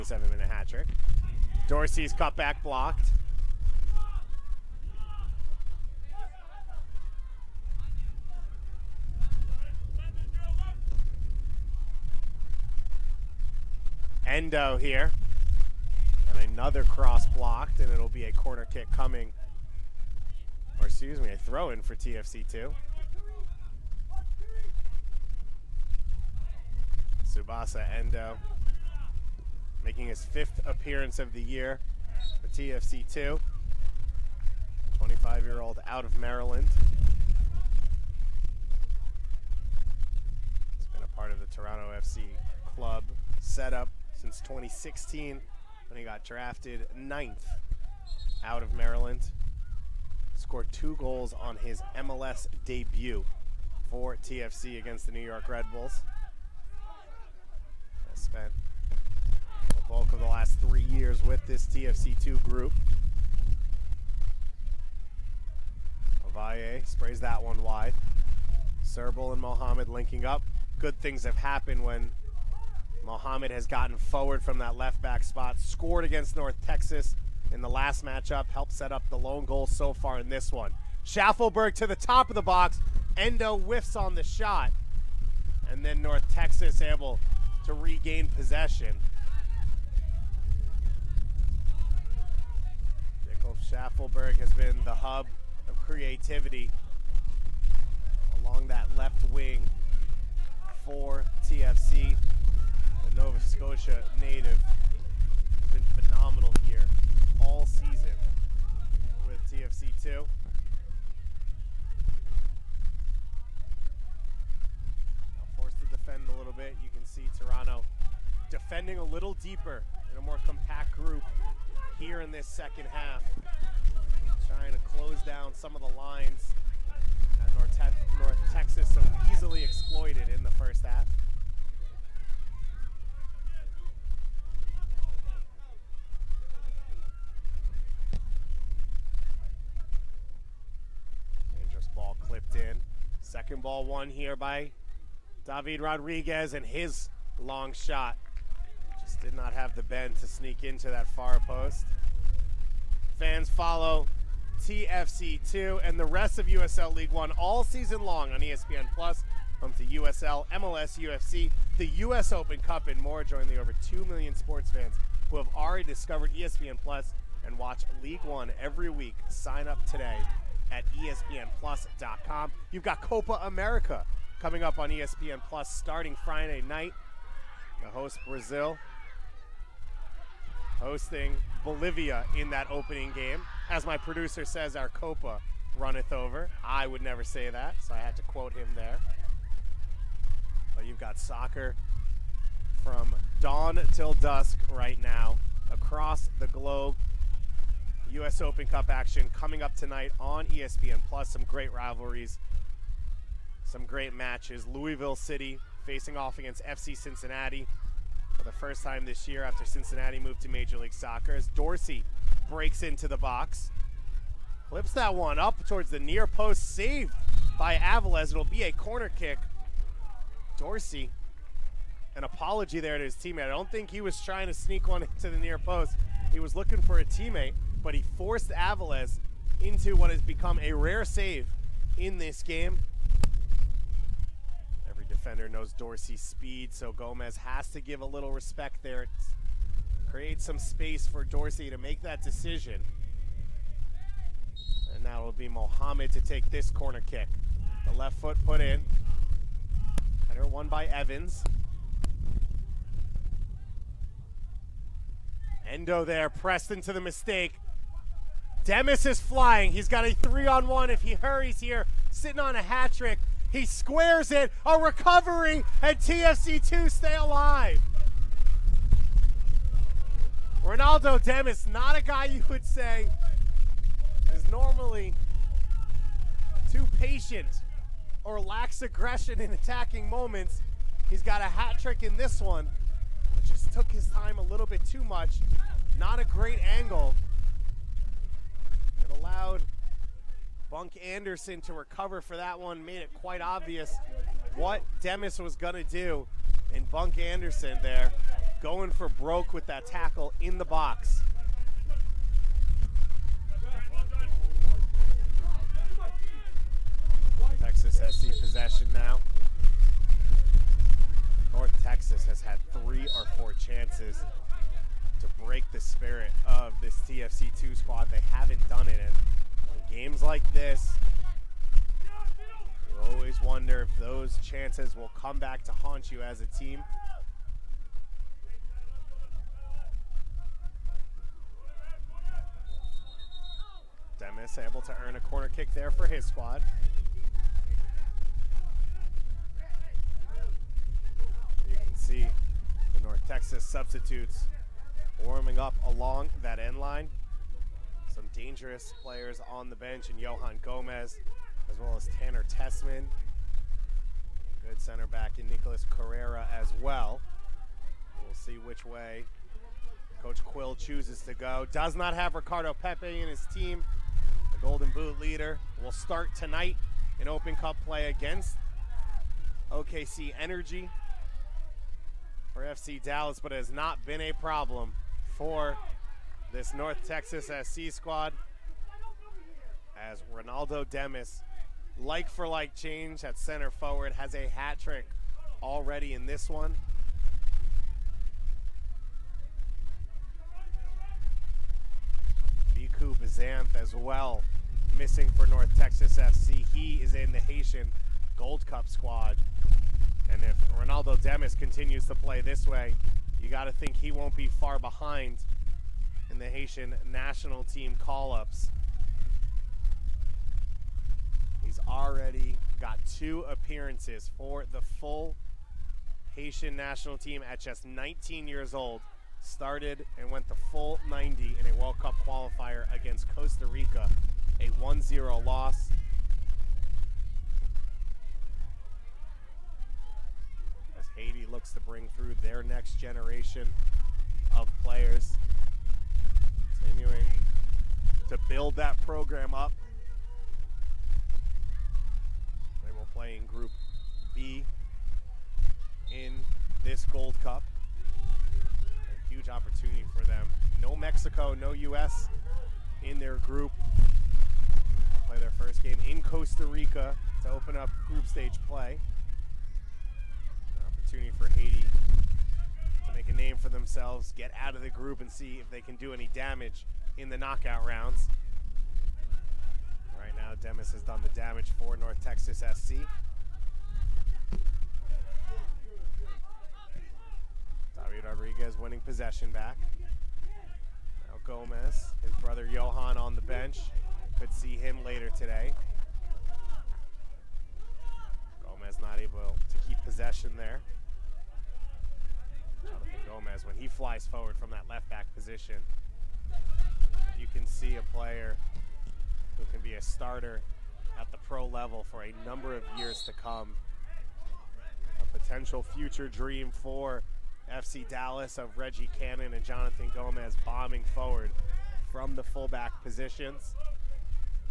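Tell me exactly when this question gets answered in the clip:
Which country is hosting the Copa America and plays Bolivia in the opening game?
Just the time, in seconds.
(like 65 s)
178 s.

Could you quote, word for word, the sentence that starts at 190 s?
But you've got soccer from dawn till dusk right now across the globe.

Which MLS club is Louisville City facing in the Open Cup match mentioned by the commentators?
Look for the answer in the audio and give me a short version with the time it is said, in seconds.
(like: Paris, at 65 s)
FC Cincinnati, at 206 s.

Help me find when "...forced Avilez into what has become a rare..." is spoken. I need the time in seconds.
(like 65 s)
228 s.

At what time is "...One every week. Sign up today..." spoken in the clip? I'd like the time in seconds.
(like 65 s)
168 s.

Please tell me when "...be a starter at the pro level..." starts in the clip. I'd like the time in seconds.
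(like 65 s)
499 s.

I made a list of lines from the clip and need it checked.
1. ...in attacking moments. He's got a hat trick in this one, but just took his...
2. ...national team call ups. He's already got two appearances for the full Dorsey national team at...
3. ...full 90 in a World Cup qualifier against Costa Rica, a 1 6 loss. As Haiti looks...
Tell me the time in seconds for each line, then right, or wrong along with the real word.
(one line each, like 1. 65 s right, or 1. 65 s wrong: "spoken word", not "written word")
1. 279 s right
2. 407 s wrong: "Haitian", not "Dorsey"
3. 420 s wrong: "0", not "6".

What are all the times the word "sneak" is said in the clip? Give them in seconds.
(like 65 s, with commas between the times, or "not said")
150 s, 224 s.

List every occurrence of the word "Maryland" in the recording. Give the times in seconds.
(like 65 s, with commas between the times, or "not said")
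36 s, 48 s.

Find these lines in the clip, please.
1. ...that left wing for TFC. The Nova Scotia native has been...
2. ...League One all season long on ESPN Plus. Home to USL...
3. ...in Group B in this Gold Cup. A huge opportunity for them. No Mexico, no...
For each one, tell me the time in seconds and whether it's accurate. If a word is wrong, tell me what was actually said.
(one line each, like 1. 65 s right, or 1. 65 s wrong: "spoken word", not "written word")
1. 98 s right
2. 156 s right
3. 443 s right.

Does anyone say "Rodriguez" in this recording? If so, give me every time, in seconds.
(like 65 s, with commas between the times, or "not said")
145 s, 478 s.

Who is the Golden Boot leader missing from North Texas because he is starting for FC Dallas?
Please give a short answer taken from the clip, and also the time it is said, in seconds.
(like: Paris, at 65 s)
Ricardo Pepi, at 362 s.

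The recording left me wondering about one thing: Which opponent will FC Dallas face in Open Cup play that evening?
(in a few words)
OKC Energy.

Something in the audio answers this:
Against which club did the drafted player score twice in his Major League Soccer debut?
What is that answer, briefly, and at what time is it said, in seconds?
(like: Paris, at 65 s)
New York Red Bulls, at 55 s.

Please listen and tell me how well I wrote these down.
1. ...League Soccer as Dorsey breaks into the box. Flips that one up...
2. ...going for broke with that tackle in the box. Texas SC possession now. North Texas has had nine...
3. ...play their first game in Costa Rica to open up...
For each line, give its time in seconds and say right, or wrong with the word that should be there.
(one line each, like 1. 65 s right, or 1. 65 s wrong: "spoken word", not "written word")
1. 210 s right
2. 298 s wrong: "three", not "nine"
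3. 455 s right.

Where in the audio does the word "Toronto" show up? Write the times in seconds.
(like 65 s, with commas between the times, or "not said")
41 s, 117 s.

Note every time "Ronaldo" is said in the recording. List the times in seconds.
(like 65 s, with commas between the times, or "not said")
270 s, 380 s, 400 s.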